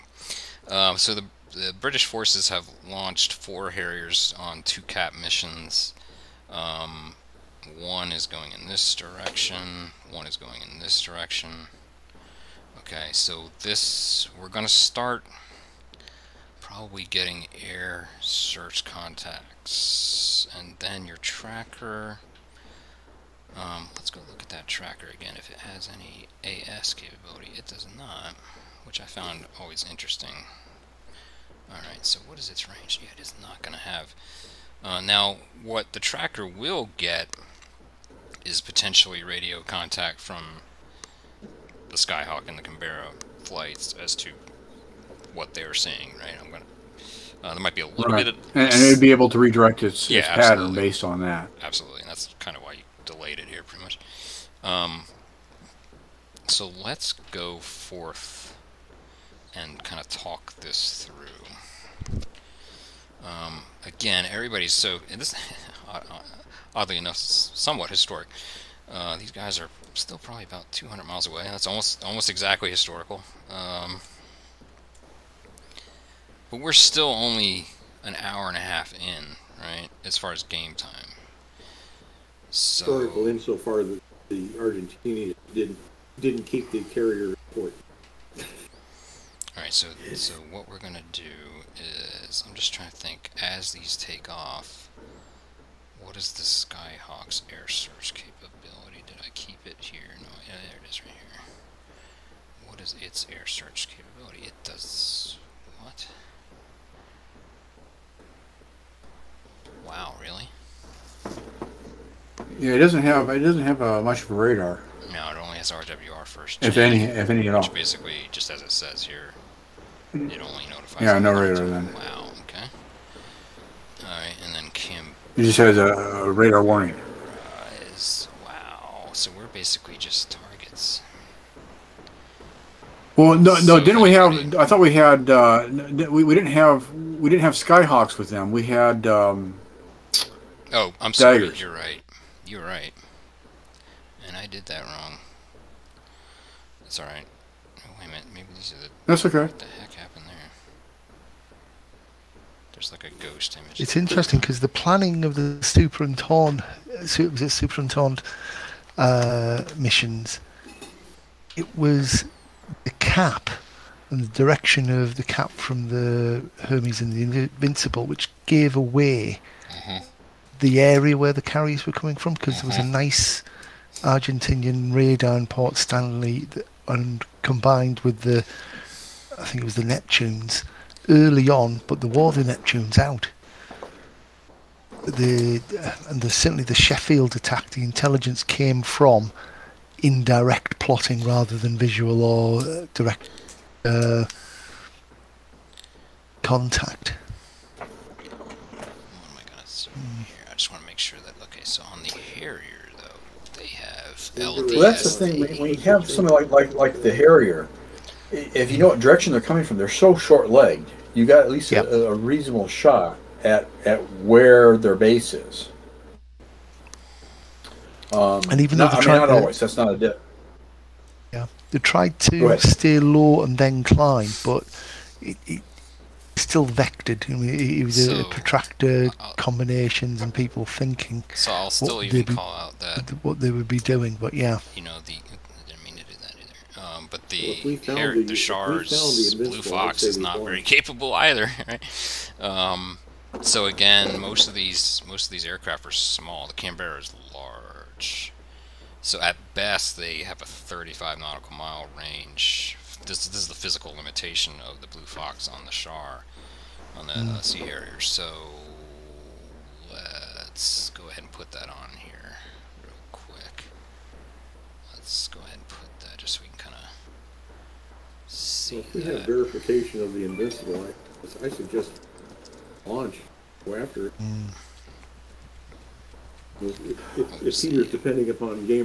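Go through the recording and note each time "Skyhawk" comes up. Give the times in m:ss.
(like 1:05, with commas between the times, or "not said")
0:41, 1:36, 2:17.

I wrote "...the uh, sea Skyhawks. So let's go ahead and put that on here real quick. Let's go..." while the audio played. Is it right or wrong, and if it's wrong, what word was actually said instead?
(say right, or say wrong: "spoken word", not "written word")
wrong: "Harrier", not "Skyhawks".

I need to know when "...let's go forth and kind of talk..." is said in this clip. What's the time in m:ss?
0:56.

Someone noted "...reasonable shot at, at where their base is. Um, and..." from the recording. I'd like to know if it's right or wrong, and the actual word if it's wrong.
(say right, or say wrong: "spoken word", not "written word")
right.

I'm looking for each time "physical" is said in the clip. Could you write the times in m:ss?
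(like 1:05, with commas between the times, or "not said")
4:13.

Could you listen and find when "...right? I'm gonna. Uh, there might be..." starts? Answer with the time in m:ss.
0:46.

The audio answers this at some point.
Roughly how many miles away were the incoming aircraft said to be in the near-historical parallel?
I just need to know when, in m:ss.
1:10.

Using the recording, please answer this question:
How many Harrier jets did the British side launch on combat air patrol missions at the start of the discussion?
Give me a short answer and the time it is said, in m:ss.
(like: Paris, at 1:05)
4, at 0:03.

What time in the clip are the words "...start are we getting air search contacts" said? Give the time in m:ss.
0:14.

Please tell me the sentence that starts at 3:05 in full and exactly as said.
The and the, certainly the Sheffield attack, the intelligence came from indirect plotting rather than visual or uh, direct uh, contact.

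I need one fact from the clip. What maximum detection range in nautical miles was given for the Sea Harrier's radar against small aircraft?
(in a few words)
35 nautical miles.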